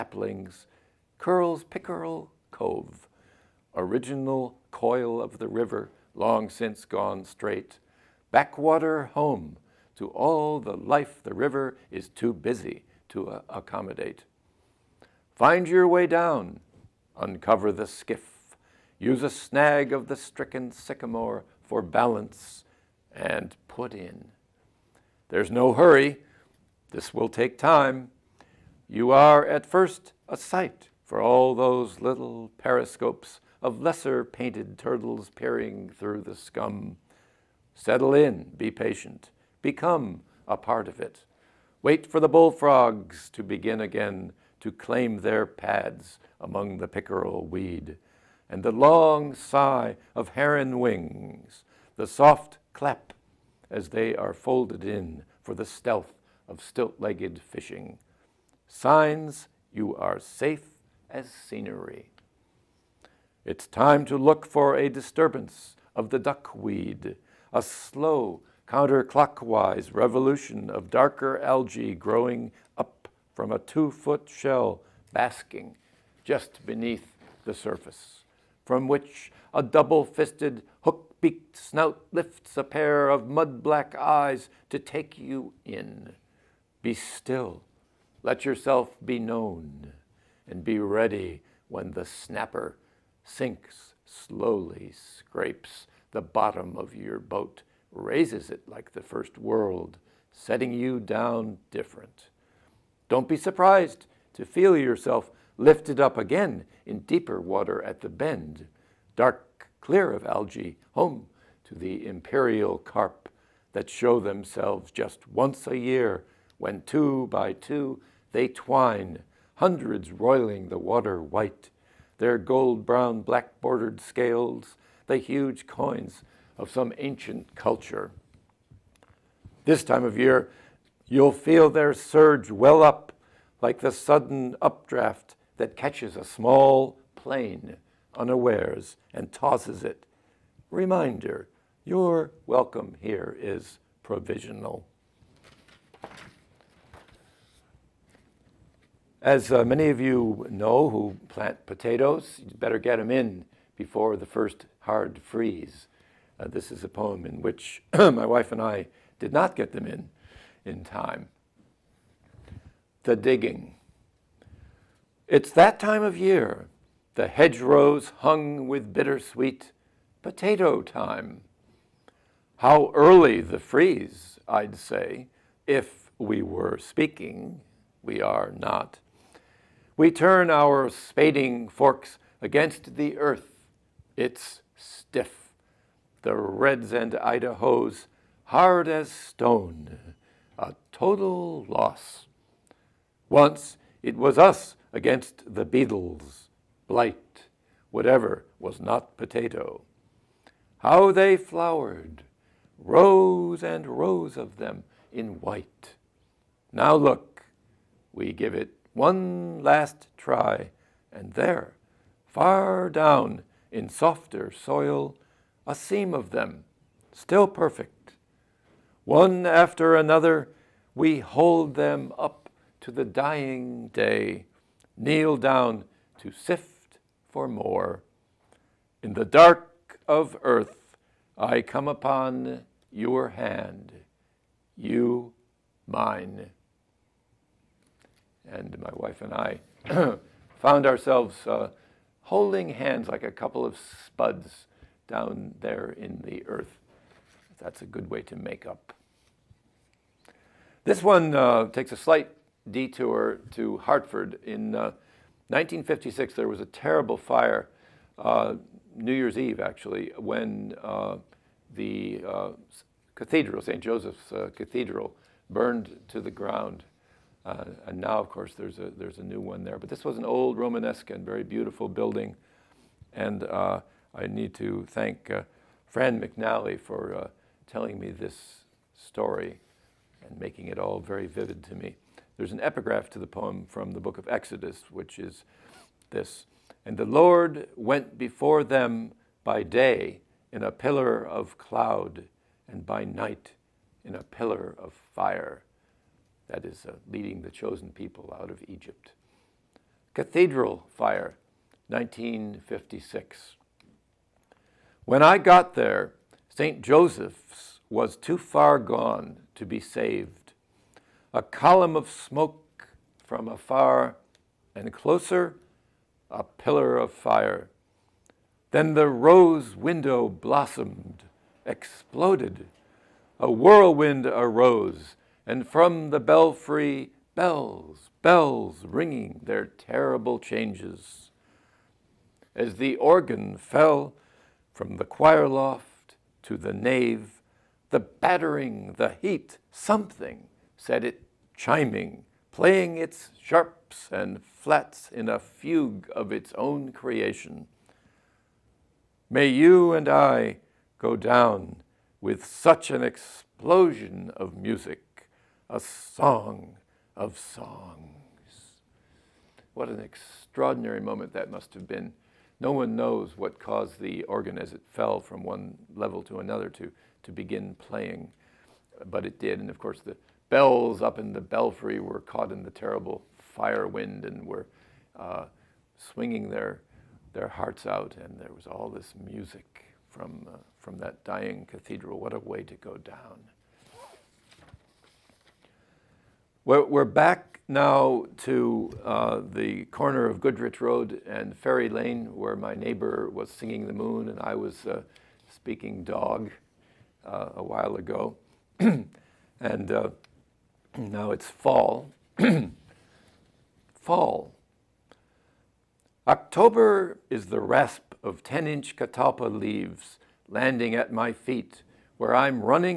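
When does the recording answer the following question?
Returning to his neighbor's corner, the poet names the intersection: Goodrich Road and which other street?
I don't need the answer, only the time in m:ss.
6:31.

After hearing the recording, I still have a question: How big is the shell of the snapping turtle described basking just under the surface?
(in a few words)
two-foot.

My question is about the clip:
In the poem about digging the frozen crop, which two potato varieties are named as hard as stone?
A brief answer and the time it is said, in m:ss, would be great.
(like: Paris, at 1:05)
Reds and Idahos, at 3:06.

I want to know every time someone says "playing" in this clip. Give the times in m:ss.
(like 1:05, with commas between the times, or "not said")
5:42, 6:07.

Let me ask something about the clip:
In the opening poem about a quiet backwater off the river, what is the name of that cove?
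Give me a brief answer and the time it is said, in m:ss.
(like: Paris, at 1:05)
Pickerel Cove, at 0:01.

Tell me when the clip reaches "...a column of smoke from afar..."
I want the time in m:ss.
5:11.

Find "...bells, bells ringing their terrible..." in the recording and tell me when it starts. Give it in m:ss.
5:27.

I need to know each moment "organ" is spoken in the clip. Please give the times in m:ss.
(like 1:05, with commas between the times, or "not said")
5:32, 6:04.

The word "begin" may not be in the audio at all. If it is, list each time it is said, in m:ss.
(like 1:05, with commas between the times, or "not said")
0:43, 6:07.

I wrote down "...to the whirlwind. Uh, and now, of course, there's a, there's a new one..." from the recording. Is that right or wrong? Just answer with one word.
wrong.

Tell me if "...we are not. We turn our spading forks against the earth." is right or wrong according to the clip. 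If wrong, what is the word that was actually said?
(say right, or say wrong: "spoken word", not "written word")
right.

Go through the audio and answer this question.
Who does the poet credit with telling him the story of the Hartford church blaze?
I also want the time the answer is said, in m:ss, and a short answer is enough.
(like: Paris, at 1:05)
Fran McNally, at 4:35.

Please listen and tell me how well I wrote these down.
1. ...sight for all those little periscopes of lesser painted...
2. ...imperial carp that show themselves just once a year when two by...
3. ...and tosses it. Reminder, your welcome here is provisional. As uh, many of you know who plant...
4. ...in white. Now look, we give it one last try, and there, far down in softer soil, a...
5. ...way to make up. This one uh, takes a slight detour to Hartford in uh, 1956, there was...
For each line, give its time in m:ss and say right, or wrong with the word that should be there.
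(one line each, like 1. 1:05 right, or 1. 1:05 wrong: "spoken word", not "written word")
1. 0:30 right
2. 1:52 right
3. 2:19 right
4. 3:25 right
5. 4:08 right.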